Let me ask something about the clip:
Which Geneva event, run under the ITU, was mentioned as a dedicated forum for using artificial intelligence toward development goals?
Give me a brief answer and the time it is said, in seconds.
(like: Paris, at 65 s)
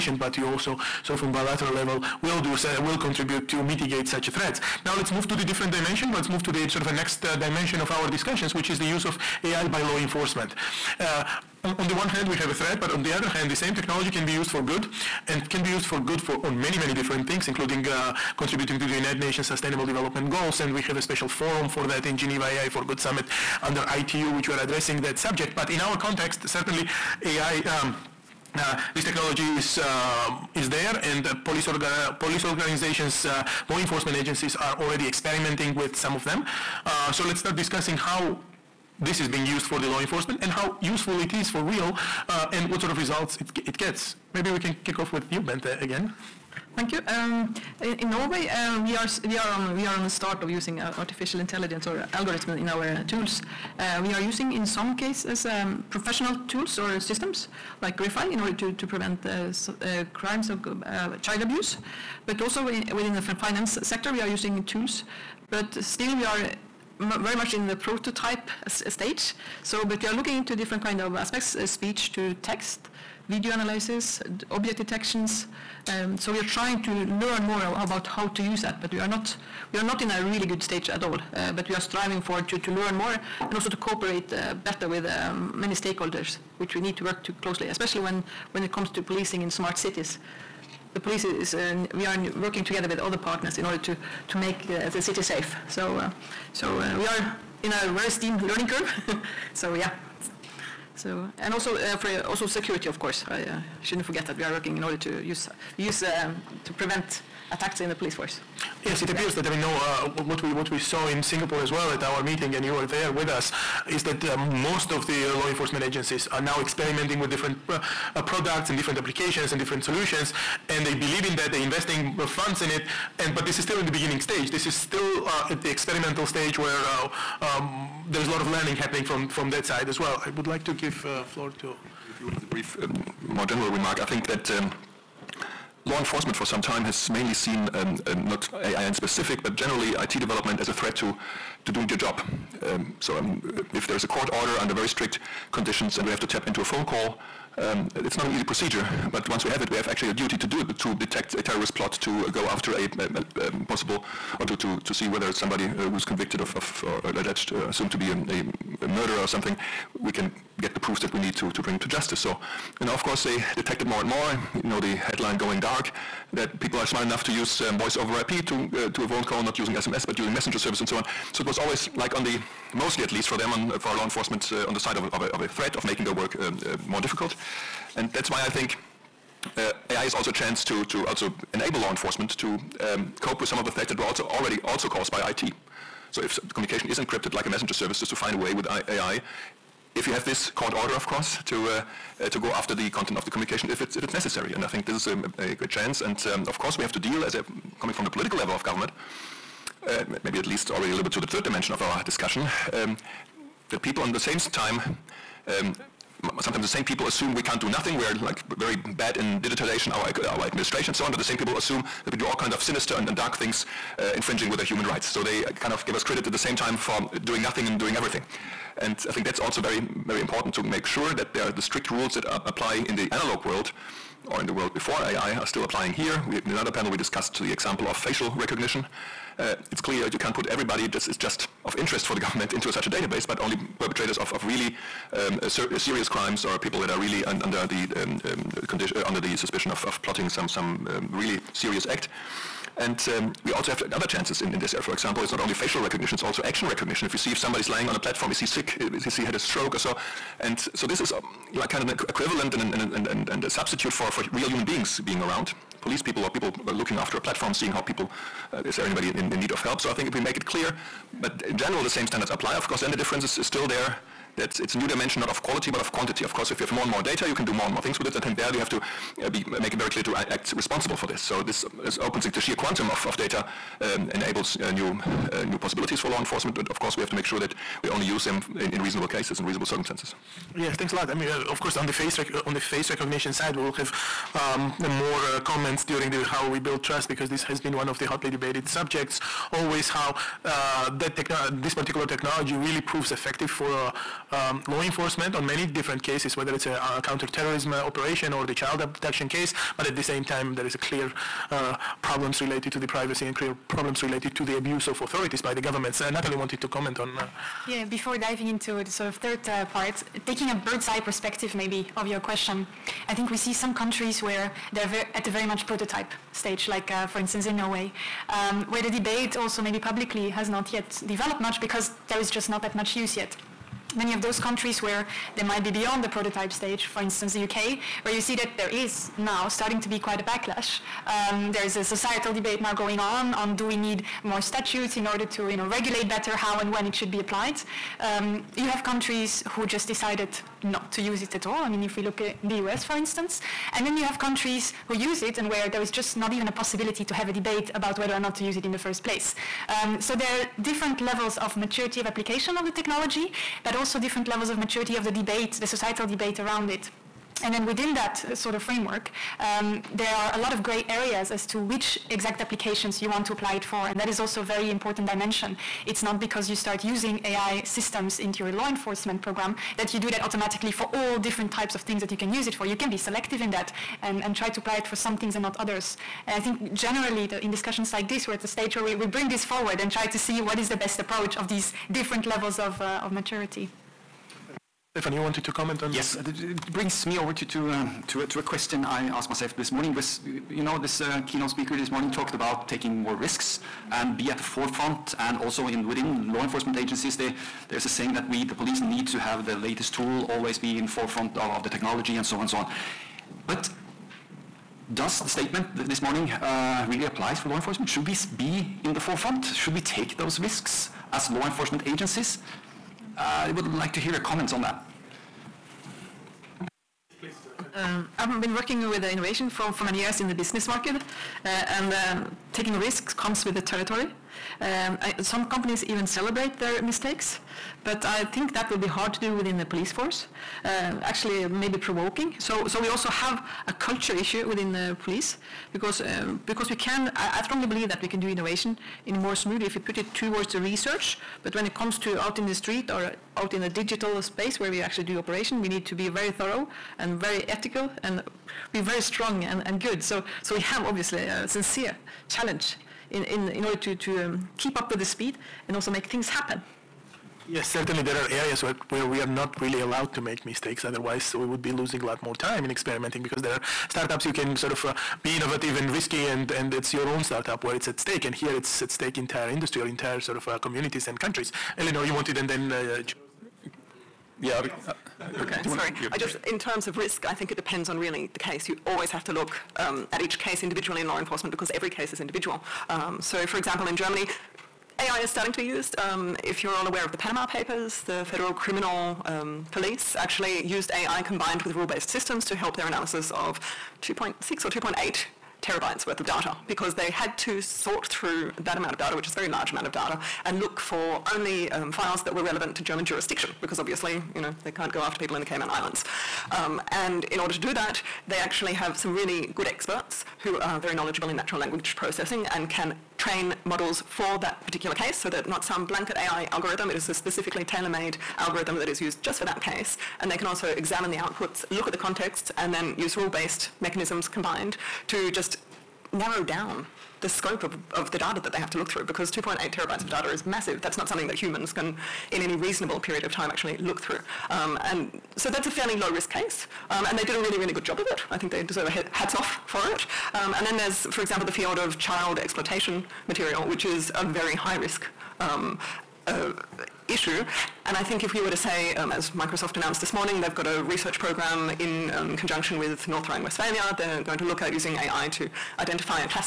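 AI for Good Summit, at 22 s.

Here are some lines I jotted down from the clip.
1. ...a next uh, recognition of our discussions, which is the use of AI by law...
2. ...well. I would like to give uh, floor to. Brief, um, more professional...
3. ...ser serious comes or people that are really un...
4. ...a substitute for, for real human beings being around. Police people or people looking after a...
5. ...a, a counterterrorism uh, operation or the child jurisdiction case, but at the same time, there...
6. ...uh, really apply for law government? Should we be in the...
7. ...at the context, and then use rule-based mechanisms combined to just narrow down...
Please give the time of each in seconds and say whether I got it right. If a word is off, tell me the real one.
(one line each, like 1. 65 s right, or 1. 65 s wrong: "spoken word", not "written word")
1. 6 s wrong: "dimension", not "recognition"
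2. 129 s wrong: "general", not "professional"
3. 235 s wrong: "crimes", not "comes"
4. 253 s right
5. 296 s wrong: "abduction", not "jurisdiction"
6. 406 s wrong: "enforcement", not "government"
7. 521 s right.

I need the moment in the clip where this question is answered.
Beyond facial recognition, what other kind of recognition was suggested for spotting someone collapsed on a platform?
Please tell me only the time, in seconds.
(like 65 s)
246 s.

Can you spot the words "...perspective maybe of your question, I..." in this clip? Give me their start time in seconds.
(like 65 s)
310 s.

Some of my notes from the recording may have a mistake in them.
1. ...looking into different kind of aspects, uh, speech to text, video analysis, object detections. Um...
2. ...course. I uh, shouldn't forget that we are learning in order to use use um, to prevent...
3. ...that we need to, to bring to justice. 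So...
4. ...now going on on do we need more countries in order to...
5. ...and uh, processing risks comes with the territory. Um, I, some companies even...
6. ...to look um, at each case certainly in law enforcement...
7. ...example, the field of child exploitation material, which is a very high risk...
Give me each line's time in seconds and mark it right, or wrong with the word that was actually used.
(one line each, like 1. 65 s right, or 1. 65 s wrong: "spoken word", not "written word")
1. 70 s right
2. 102 s wrong: "working", not "learning"
3. 160 s right
4. 332 s wrong: "statutes", not "countries"
5. 421 s wrong: "taking", not "processing"
6. 479 s wrong: "individually", not "certainly"
7. 541 s right.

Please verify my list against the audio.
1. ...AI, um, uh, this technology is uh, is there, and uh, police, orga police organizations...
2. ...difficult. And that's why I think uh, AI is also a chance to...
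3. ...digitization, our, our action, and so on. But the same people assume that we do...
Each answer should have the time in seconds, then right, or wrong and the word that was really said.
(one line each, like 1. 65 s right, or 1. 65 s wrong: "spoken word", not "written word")
1. 27 s right
2. 176 s right
3. 209 s wrong: "administration", not "action".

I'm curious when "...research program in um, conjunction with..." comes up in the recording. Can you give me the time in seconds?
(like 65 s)
550 s.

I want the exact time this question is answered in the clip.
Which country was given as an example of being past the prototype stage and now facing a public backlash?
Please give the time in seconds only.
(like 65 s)
327 s.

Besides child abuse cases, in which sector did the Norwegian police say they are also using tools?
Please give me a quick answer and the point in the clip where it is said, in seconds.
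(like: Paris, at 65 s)
finance sector, at 63 s.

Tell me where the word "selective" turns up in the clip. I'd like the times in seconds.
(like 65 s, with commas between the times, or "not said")
372 s.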